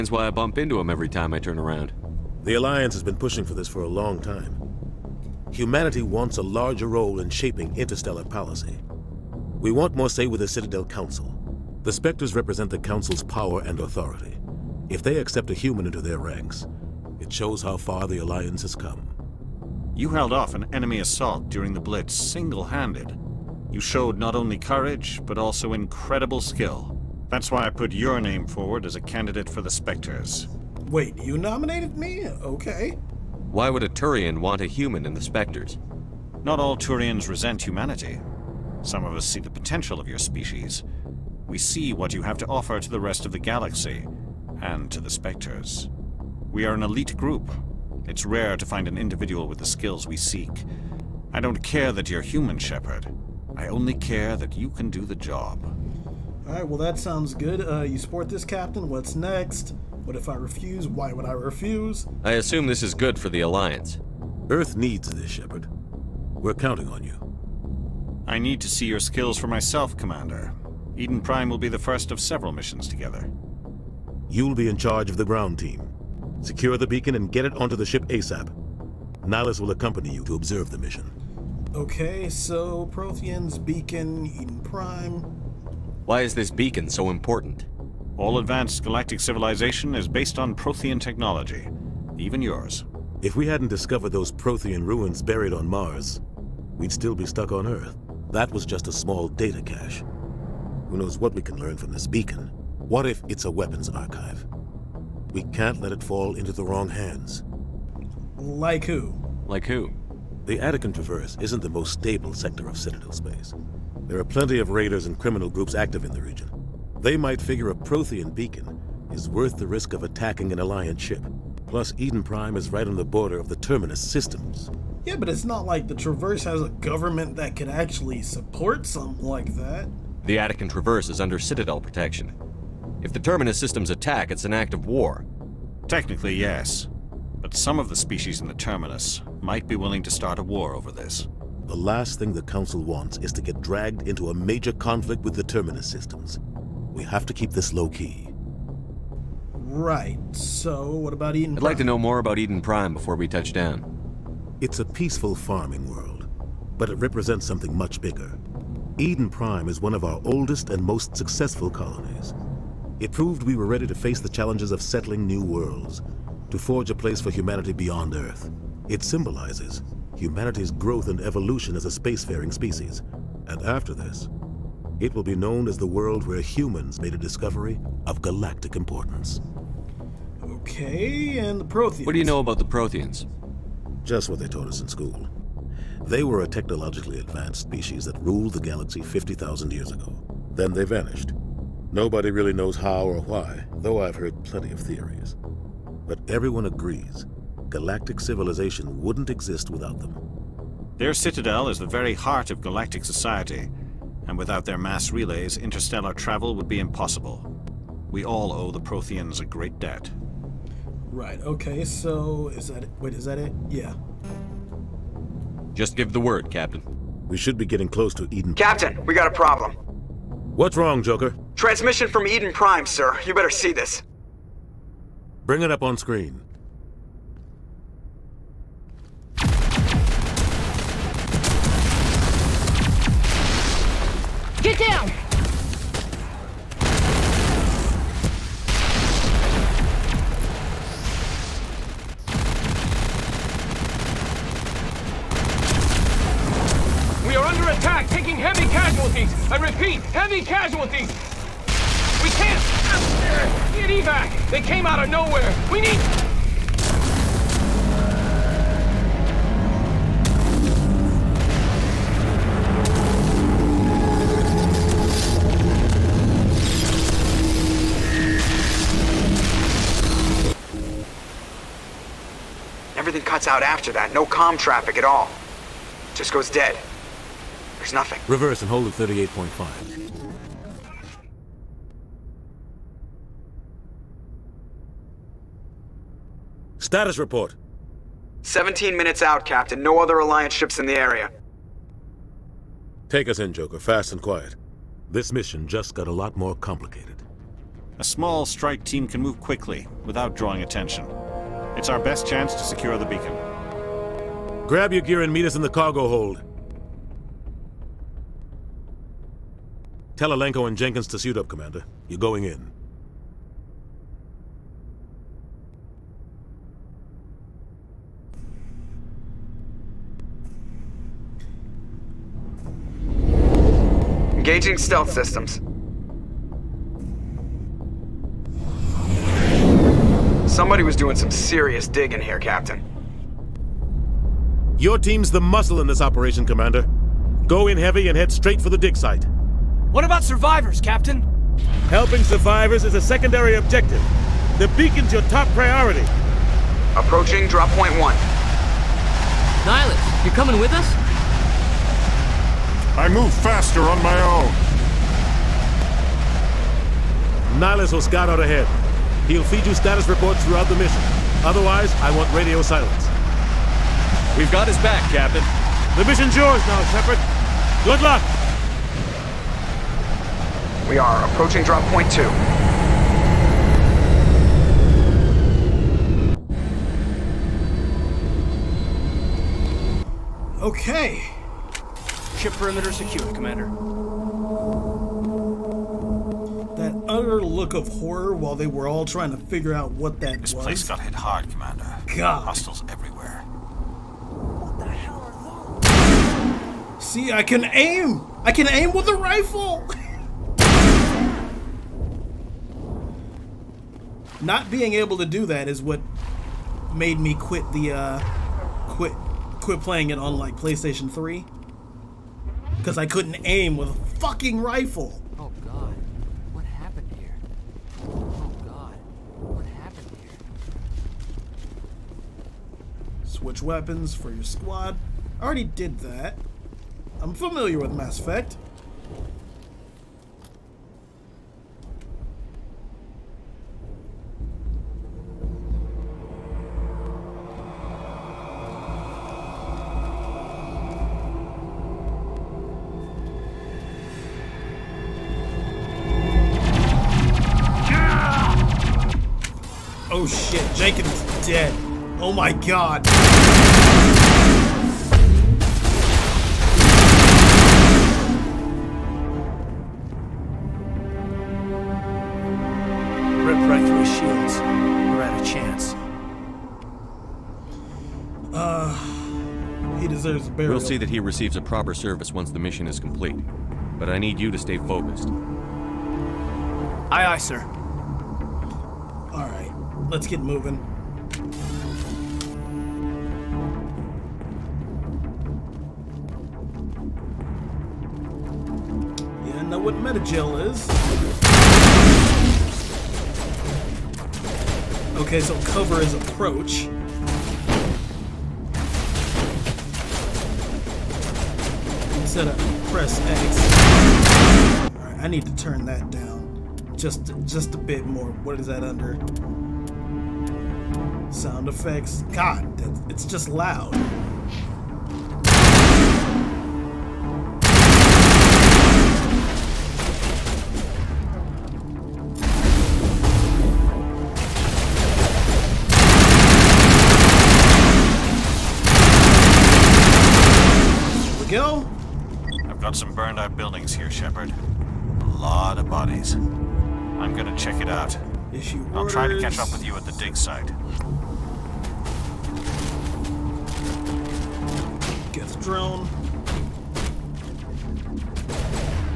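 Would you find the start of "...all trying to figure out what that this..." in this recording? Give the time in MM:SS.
06:28.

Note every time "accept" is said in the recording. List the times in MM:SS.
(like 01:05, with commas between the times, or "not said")
00:15.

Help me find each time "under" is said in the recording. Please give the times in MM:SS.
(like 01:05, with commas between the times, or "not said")
02:11, 08:28.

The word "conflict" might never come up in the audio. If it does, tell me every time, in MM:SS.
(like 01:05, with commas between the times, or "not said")
02:24.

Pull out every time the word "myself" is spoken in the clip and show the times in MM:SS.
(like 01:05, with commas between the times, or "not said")
01:09.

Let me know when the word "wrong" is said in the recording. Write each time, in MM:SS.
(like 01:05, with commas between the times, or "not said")
01:46, 03:40.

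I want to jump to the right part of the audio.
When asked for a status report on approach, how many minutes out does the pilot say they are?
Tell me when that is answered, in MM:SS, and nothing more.
04:48.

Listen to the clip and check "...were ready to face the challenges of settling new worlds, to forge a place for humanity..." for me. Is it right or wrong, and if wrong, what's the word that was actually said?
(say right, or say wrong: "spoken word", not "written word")
right.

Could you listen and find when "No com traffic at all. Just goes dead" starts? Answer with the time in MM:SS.
04:34.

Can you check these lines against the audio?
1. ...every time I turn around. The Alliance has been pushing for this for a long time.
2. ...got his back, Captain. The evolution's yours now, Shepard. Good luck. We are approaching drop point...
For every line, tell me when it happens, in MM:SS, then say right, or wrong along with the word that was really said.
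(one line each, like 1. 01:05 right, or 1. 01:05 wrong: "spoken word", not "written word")
1. 00:00 right
2. 06:04 wrong: "mission", not "evolution".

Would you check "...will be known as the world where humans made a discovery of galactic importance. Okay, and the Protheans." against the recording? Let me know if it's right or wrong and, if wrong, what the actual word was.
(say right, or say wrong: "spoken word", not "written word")
right.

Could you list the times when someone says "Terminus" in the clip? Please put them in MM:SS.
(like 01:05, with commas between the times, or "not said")
02:03, 02:13, 02:18, 02:25.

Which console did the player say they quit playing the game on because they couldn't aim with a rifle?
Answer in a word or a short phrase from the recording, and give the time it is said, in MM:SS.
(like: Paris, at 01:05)
PlayStation 3, at 06:50.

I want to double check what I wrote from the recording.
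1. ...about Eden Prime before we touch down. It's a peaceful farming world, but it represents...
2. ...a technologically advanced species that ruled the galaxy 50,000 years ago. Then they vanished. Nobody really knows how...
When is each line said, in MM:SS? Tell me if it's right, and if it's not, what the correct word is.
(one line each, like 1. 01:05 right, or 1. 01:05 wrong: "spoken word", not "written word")
1. 02:32 right
2. 03:06 right.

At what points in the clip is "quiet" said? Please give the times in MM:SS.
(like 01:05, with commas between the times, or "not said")
04:54.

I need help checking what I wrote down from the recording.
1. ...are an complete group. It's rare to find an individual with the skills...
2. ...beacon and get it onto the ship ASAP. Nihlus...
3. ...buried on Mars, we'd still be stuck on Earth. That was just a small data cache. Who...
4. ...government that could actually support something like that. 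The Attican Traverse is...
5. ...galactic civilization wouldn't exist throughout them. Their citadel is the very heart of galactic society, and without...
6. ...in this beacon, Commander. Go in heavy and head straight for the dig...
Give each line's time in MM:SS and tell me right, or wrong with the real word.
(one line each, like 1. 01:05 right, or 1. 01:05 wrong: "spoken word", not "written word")
1. 00:46 wrong: "elite", not "complete"
2. 01:16 right
3. 01:35 right
4. 02:06 right
5. 03:17 wrong: "without", not "throughout"
6. 05:35 wrong: "operation", not "beacon".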